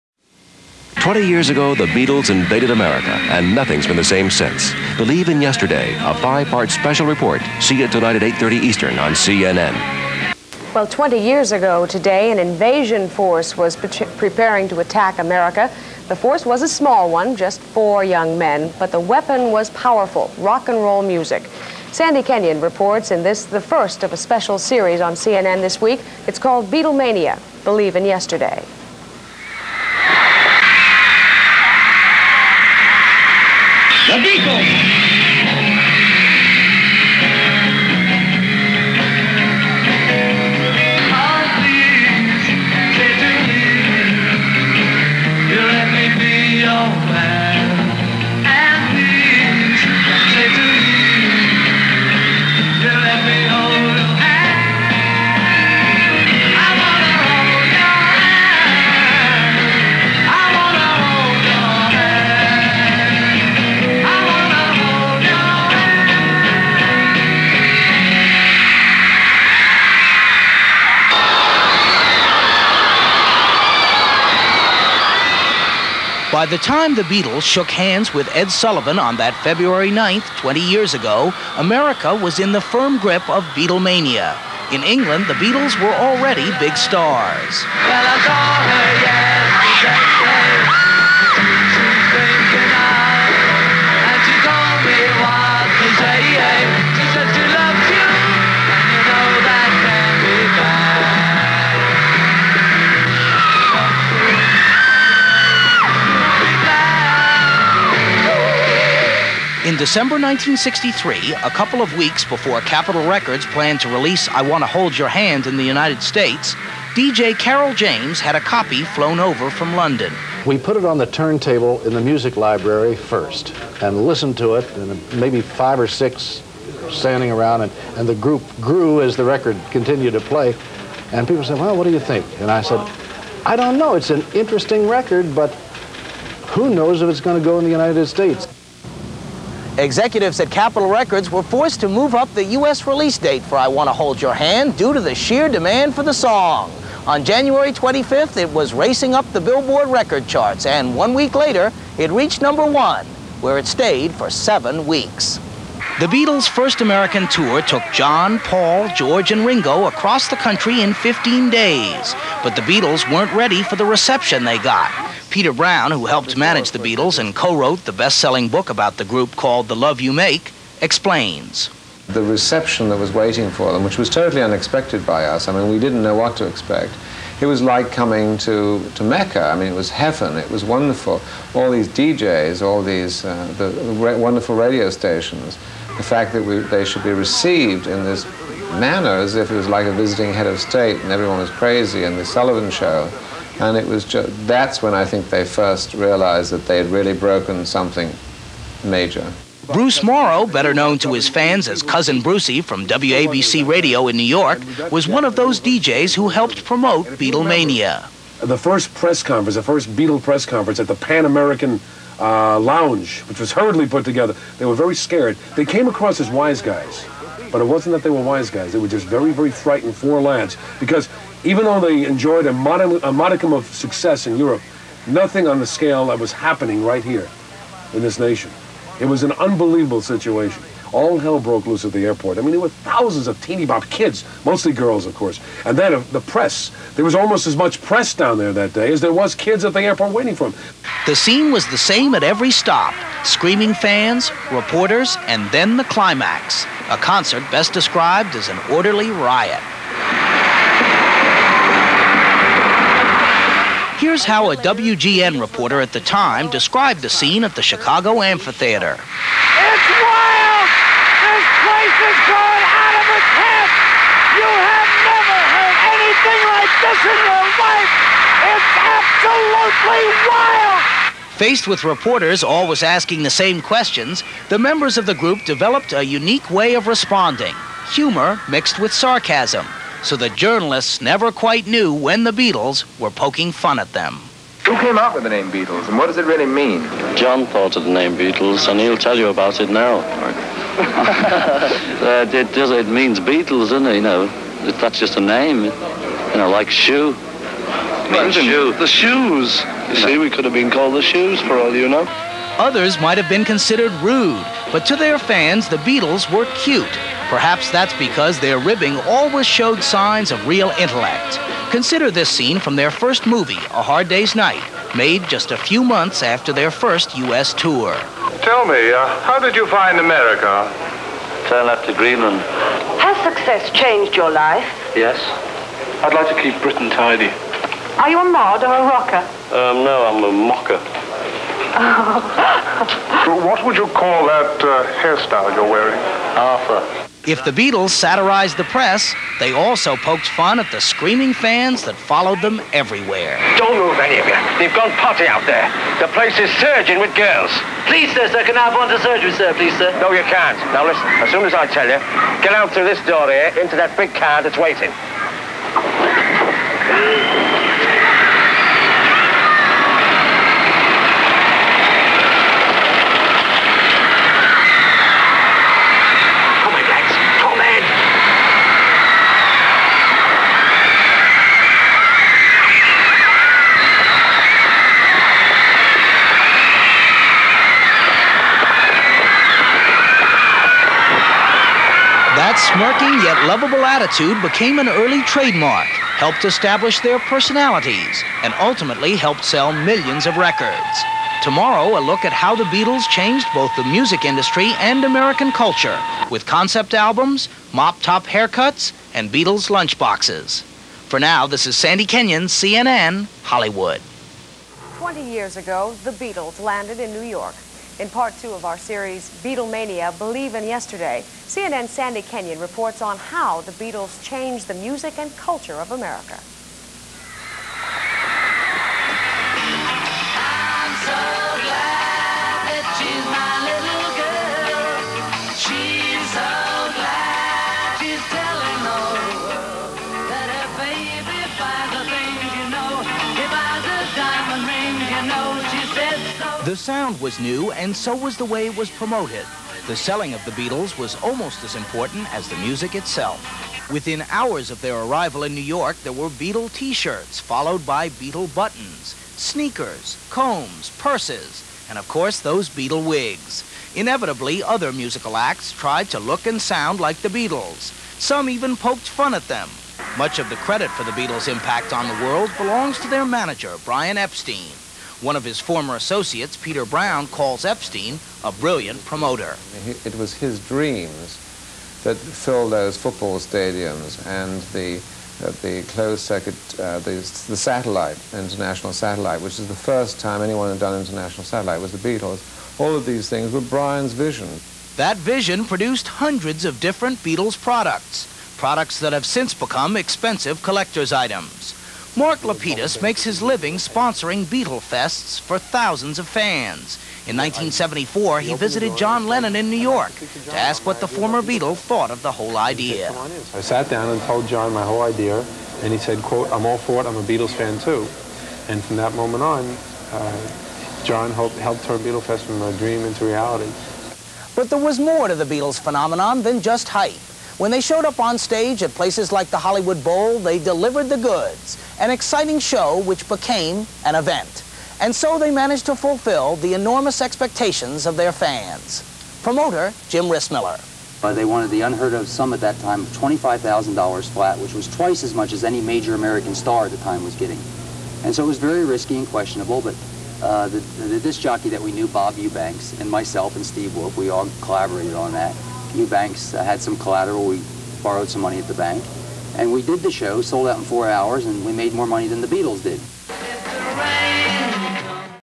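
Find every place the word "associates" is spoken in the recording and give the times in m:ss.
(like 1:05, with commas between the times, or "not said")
7:45.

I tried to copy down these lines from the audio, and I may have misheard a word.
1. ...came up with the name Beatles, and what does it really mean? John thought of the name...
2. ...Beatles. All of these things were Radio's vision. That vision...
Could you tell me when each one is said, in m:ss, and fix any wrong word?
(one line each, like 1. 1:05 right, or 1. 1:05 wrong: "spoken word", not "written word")
1. 4:44 right
2. 8:01 wrong: "Brian", not "Radio".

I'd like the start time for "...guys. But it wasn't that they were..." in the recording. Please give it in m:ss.
3:36.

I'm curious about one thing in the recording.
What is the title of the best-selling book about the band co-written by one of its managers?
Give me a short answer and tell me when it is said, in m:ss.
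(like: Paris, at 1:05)
The Love You Make, at 2:49.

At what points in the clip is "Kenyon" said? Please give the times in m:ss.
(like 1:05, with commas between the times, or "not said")
0:22, 6:42, 6:52.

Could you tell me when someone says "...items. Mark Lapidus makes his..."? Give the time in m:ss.
8:11.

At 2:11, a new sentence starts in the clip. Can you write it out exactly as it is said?
And people said, Well, what do you think?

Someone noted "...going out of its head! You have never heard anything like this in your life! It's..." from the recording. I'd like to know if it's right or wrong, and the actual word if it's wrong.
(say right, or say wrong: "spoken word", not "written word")
right.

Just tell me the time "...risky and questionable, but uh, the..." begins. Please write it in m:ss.
8:58.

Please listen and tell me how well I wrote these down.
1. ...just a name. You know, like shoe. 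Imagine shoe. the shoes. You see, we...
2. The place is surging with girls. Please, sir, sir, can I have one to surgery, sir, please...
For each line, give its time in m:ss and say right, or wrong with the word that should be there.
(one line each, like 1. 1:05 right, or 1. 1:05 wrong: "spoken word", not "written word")
1. 4:54 right
2. 5:46 right.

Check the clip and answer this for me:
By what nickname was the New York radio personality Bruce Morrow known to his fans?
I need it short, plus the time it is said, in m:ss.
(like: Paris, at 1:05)
Cousin Brucey, at 3:21.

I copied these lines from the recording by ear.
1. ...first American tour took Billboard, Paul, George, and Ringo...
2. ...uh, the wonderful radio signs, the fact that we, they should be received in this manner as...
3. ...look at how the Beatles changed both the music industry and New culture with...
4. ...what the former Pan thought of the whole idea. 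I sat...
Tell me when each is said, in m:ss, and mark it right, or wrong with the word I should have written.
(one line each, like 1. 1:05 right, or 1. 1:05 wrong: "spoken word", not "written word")
1. 2:36 wrong: "John", not "Billboard"
2. 3:03 wrong: "stations", not "signs"
3. 6:32 wrong: "American", not "New"
4. 8:20 wrong: "Beatle", not "Pan".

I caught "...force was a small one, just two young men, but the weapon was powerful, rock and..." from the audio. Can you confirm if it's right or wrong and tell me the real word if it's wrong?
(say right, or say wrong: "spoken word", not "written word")
wrong: "four", not "two".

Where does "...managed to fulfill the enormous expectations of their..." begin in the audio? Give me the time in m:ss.
8:45.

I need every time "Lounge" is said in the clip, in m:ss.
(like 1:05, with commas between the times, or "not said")
3:32.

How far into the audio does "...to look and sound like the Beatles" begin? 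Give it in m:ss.
7:36.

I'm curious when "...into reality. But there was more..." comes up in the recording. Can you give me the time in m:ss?
8:33.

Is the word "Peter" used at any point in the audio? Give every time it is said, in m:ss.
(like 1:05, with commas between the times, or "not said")
2:45, 7:46.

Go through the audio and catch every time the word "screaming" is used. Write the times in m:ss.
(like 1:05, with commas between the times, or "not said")
4:03, 5:40.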